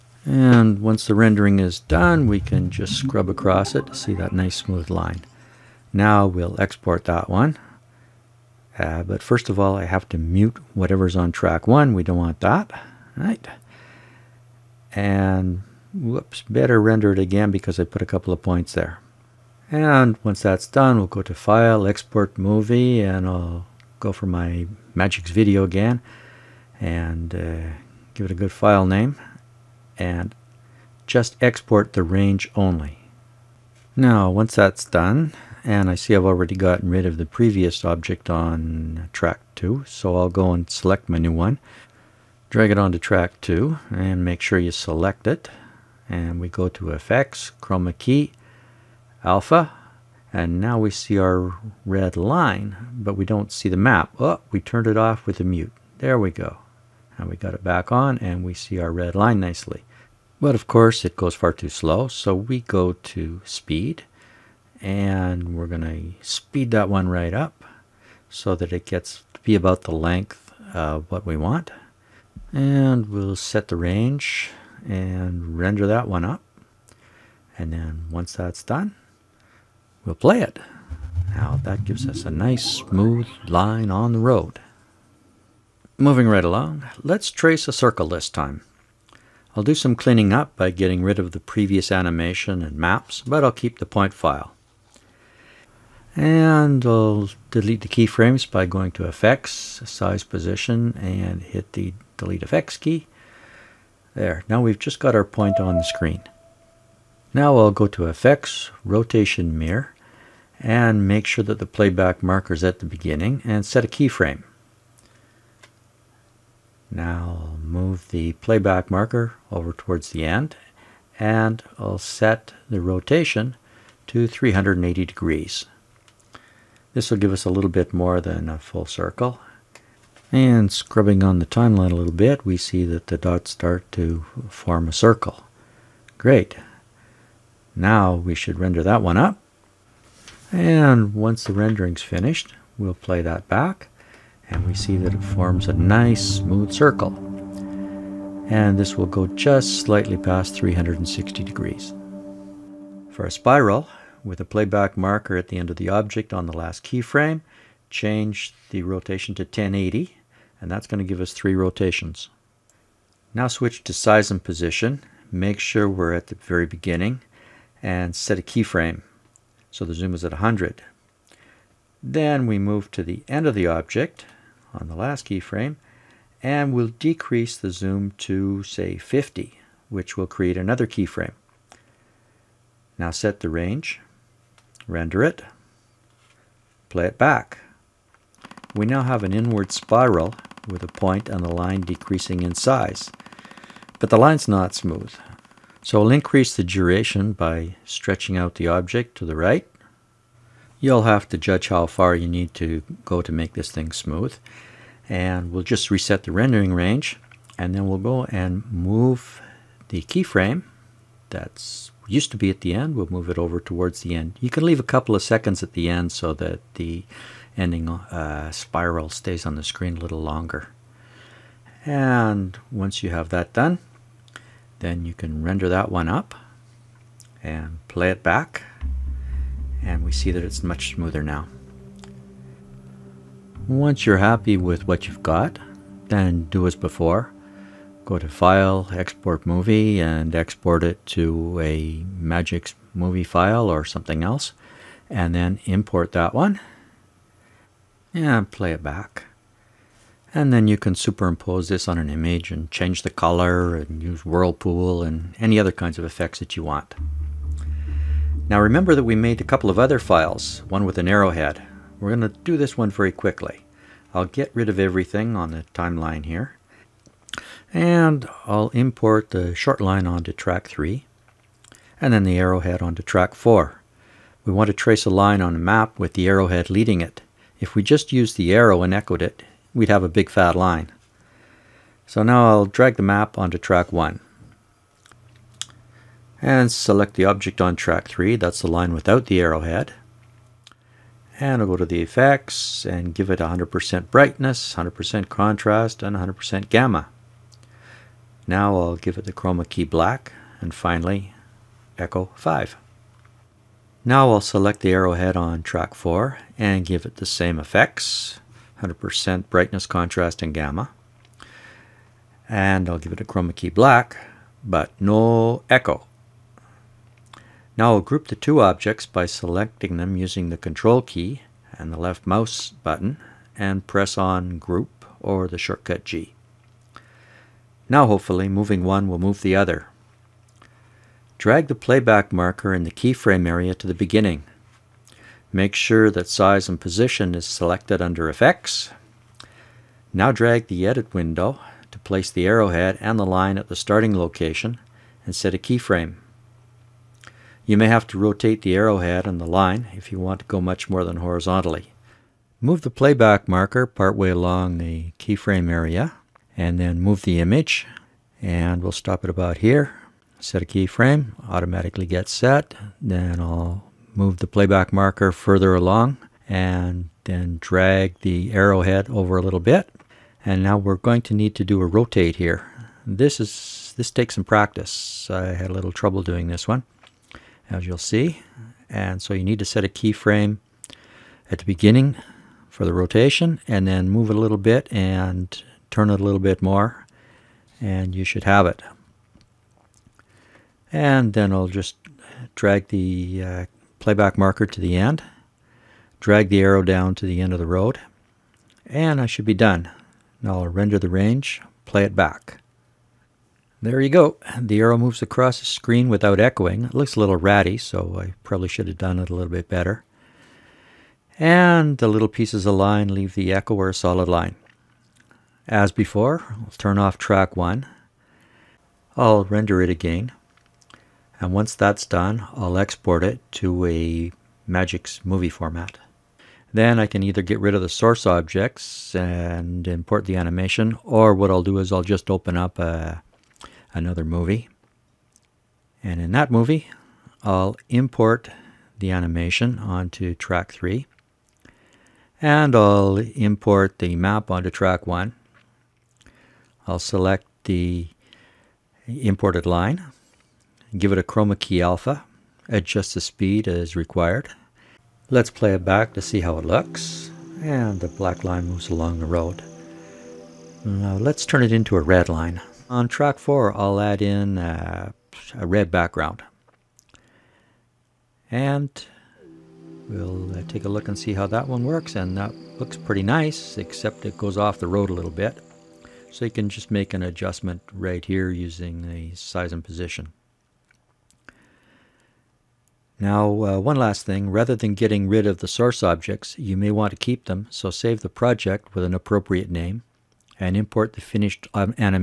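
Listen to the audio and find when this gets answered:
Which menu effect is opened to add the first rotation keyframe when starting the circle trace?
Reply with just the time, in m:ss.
1:48.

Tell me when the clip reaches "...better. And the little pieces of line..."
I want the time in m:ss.
6:49.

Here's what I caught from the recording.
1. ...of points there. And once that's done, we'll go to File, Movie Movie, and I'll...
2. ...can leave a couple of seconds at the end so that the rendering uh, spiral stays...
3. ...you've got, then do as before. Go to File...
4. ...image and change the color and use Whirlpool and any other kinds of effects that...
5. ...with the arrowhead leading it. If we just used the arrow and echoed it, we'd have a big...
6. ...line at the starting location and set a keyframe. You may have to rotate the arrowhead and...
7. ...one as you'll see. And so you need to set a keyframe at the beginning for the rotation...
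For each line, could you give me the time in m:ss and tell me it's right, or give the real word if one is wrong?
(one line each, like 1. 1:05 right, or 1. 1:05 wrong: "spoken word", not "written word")
1. 0:18 wrong: "Export", not "Movie"
2. 3:34 wrong: "ending", not "rendering"
3. 3:55 right
4. 4:12 right
5. 4:35 right
6. 5:43 right
7. 6:16 right.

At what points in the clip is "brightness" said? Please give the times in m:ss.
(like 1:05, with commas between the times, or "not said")
4:54, 5:09.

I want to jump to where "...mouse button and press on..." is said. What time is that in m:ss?
5:22.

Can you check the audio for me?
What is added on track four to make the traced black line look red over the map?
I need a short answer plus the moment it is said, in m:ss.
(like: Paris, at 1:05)
a red background, at 7:45.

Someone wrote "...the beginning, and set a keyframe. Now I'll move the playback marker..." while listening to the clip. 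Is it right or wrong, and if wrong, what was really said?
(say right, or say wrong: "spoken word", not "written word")
right.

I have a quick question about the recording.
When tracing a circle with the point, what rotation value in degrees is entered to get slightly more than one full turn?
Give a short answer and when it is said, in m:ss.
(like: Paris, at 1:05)
380, at 2:04.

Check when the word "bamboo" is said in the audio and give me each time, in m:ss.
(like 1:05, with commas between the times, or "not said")
not said.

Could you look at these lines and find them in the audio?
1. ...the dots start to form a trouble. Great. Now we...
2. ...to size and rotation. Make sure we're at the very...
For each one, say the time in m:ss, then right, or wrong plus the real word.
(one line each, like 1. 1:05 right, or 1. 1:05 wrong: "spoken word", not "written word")
1. 2:13 wrong: "circle", not "trouble"
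2. 2:43 wrong: "position", not "rotation".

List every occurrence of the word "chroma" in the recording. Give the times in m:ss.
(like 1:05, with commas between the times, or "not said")
0:47, 4:59, 5:13, 7:31.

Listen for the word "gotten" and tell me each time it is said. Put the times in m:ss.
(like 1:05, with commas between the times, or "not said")
0:36.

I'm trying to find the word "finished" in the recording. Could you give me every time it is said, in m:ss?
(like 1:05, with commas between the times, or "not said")
2:22, 8:11.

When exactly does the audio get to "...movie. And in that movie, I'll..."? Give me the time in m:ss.
7:14.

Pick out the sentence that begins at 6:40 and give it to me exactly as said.
Now I'll render the range, play it back.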